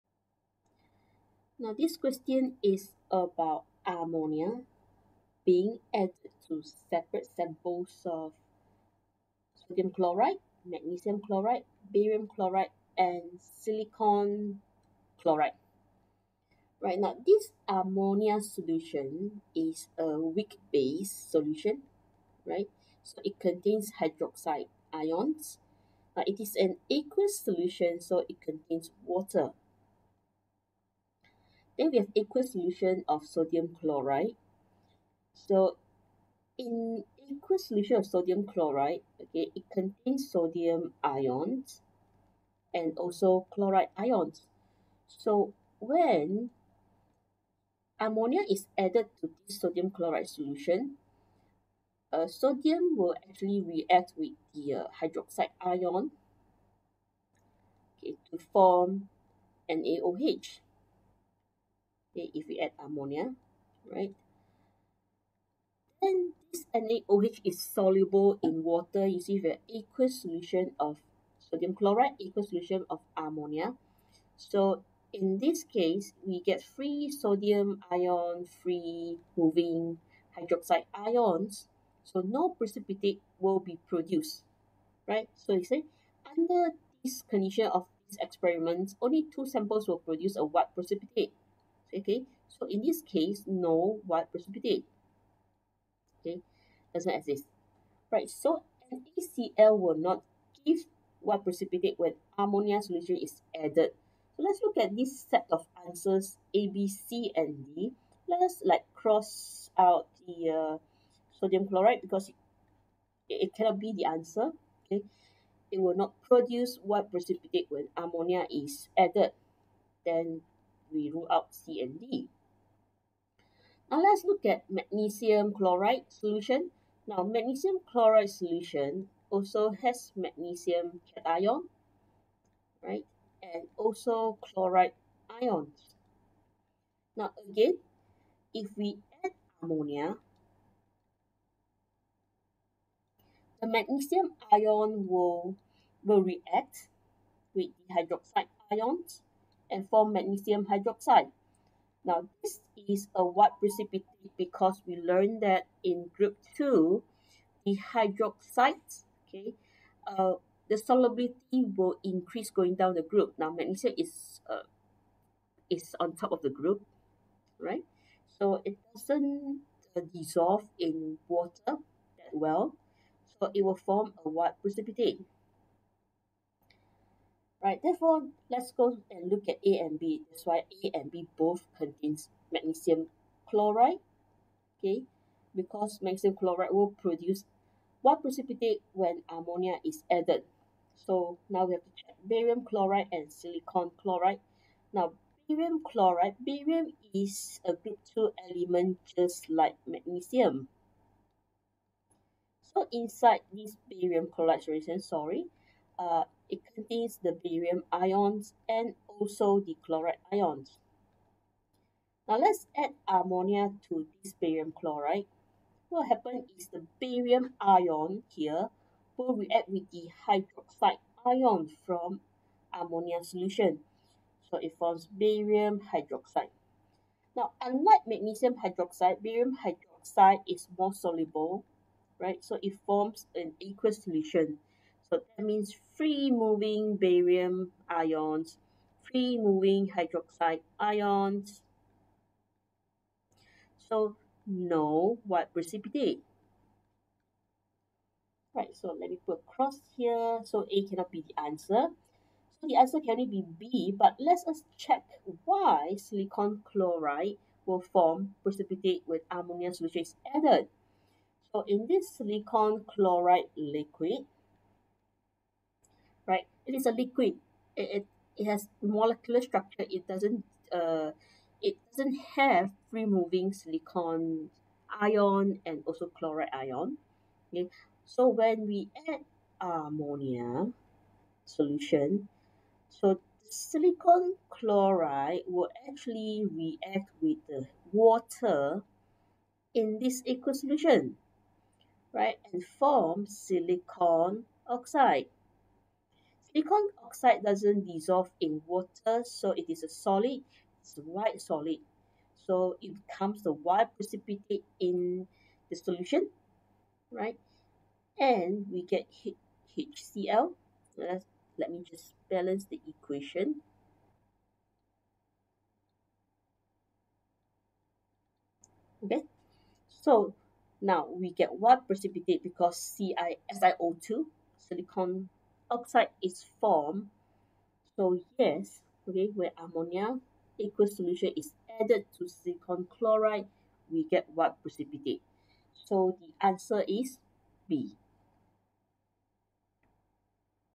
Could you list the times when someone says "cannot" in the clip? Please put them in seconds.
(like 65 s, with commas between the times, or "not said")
113 s, 250 s.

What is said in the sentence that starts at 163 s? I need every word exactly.
Now, magnesium is, uh, is on top of the group, right?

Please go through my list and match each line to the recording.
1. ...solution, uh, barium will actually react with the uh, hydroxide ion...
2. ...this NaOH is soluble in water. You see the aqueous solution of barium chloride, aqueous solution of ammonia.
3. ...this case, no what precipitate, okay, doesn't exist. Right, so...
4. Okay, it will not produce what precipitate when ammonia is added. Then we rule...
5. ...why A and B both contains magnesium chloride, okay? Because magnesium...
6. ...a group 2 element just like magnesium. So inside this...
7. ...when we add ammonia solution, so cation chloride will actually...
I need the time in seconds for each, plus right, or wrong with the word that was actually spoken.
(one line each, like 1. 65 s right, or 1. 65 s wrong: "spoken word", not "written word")
1. 50 s wrong: "sodium", not "barium"
2. 66 s wrong: "sodium", not "barium"
3. 92 s right
4. 114 s right
5. 180 s right
6. 197 s right
7. 278 s wrong: "silicon", not "cation".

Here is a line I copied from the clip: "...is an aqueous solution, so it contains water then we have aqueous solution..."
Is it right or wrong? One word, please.
right.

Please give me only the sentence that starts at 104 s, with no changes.
So let's look at this set of answers A, B, C, and D.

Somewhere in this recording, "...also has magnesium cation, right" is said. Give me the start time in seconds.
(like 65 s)
129 s.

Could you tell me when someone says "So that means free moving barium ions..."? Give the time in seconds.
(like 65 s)
235 s.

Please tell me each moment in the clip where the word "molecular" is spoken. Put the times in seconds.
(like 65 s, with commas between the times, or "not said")
268 s.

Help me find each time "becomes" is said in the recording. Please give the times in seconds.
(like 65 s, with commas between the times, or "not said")
303 s.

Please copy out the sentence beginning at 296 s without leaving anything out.
Silicon oxide doesn't dissolve in water, so it is a solid, it's a white solid.